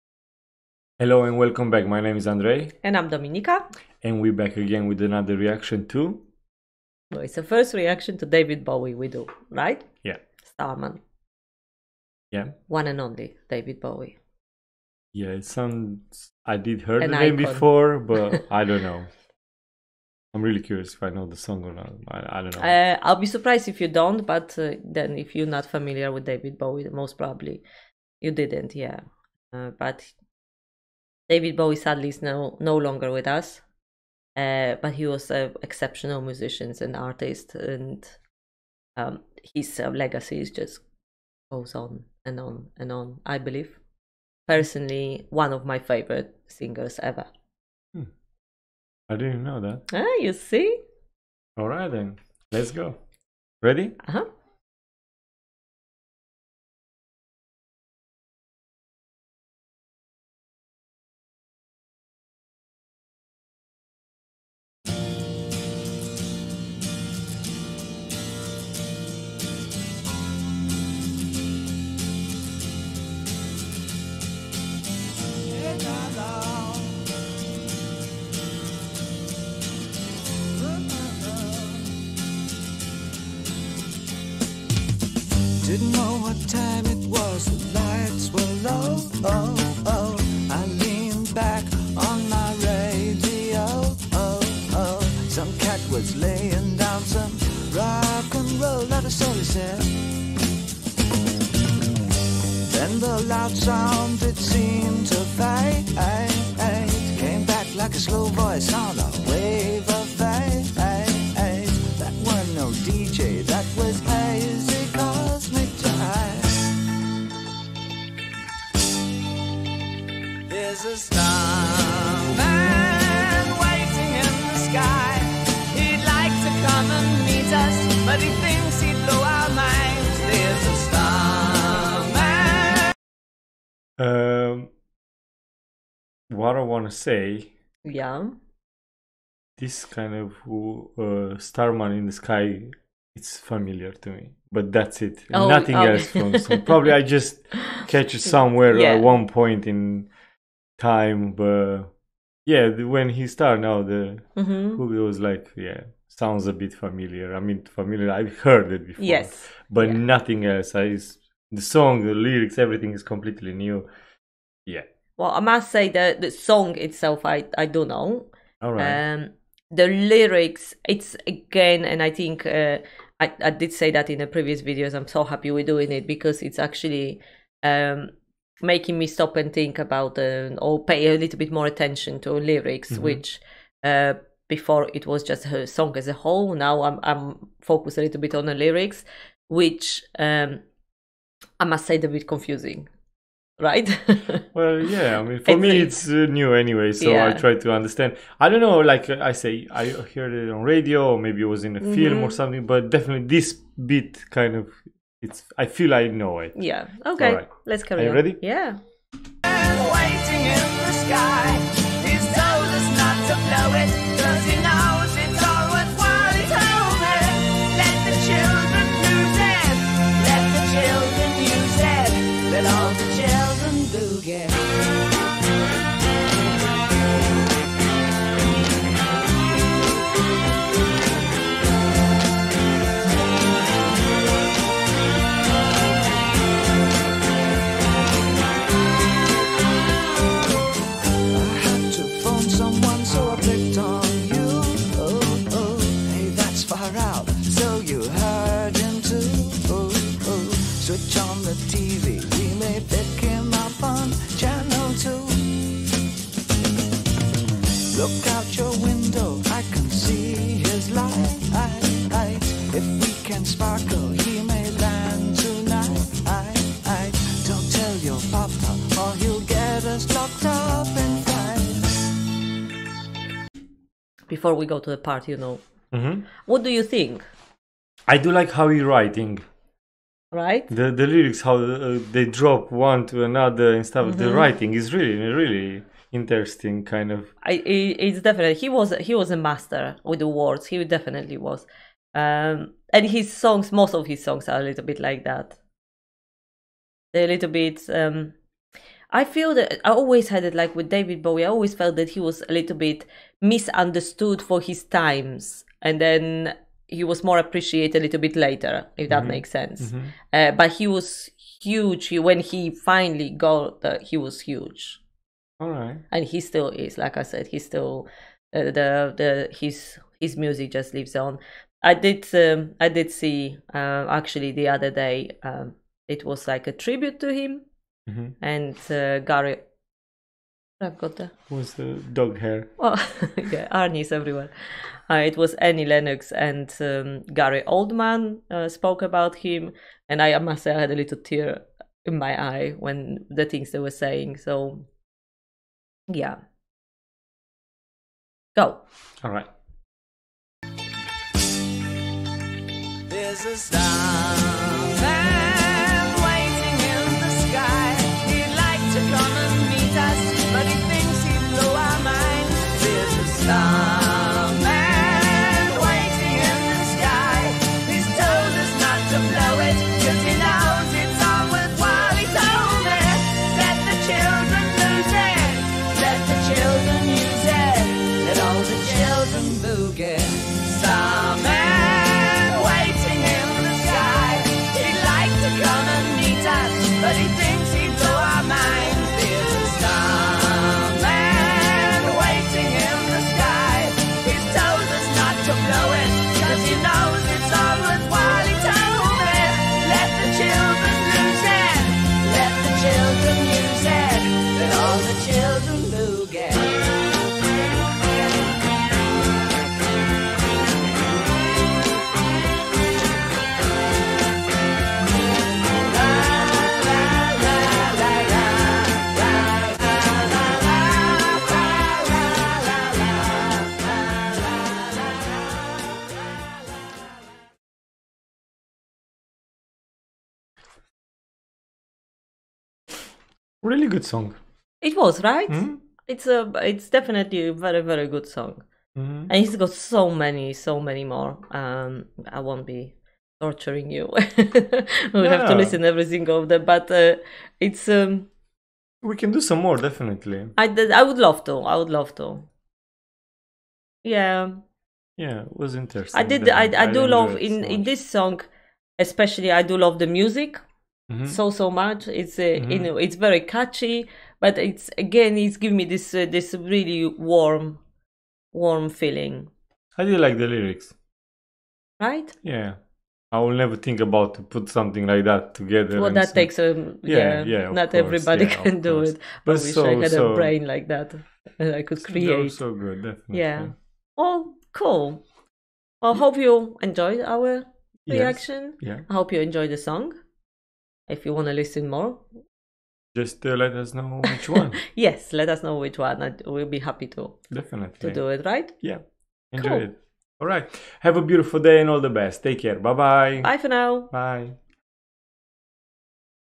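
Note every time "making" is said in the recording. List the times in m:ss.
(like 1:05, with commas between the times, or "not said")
2:58.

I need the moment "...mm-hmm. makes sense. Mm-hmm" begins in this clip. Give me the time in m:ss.
5:09.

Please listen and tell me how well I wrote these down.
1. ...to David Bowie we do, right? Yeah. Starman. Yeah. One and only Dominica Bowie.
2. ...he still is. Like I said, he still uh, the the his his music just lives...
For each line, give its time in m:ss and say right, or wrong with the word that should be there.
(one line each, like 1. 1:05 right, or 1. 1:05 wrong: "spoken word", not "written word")
1. 0:08 wrong: "David", not "Dominica"
2. 5:16 right.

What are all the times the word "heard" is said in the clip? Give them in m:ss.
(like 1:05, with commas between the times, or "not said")
0:16, 2:38, 3:19.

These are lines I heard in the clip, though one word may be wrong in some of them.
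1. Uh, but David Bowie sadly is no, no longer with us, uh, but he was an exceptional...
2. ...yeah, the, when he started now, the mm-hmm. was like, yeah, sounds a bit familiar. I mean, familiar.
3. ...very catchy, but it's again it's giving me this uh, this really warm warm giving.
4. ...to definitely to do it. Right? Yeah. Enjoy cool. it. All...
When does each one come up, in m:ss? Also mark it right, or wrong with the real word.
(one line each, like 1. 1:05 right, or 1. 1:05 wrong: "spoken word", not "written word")
1. 0:29 right
2. 2:32 right
3. 7:43 wrong: "feeling", not "giving"
4. 8:17 right.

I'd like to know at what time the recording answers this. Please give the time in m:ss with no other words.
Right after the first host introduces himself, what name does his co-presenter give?
0:03.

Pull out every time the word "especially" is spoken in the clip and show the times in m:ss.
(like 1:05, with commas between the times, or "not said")
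7:38.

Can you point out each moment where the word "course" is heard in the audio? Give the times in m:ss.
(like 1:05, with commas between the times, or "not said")
7:57.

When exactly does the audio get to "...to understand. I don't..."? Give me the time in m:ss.
3:17.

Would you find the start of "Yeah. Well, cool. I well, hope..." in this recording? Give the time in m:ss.
8:03.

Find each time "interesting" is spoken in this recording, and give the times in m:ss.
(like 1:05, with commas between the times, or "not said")
4:46, 7:35.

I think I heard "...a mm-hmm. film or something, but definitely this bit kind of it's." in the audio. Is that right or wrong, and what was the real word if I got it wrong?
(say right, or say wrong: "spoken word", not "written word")
right.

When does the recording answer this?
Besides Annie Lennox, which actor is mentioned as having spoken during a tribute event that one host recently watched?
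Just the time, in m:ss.
5:37.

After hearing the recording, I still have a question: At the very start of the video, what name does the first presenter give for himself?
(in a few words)
Andrei.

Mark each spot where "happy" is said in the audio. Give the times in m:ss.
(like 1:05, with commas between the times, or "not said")
2:55, 8:16.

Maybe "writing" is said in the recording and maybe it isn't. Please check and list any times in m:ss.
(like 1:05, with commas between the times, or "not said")
4:38, 4:44.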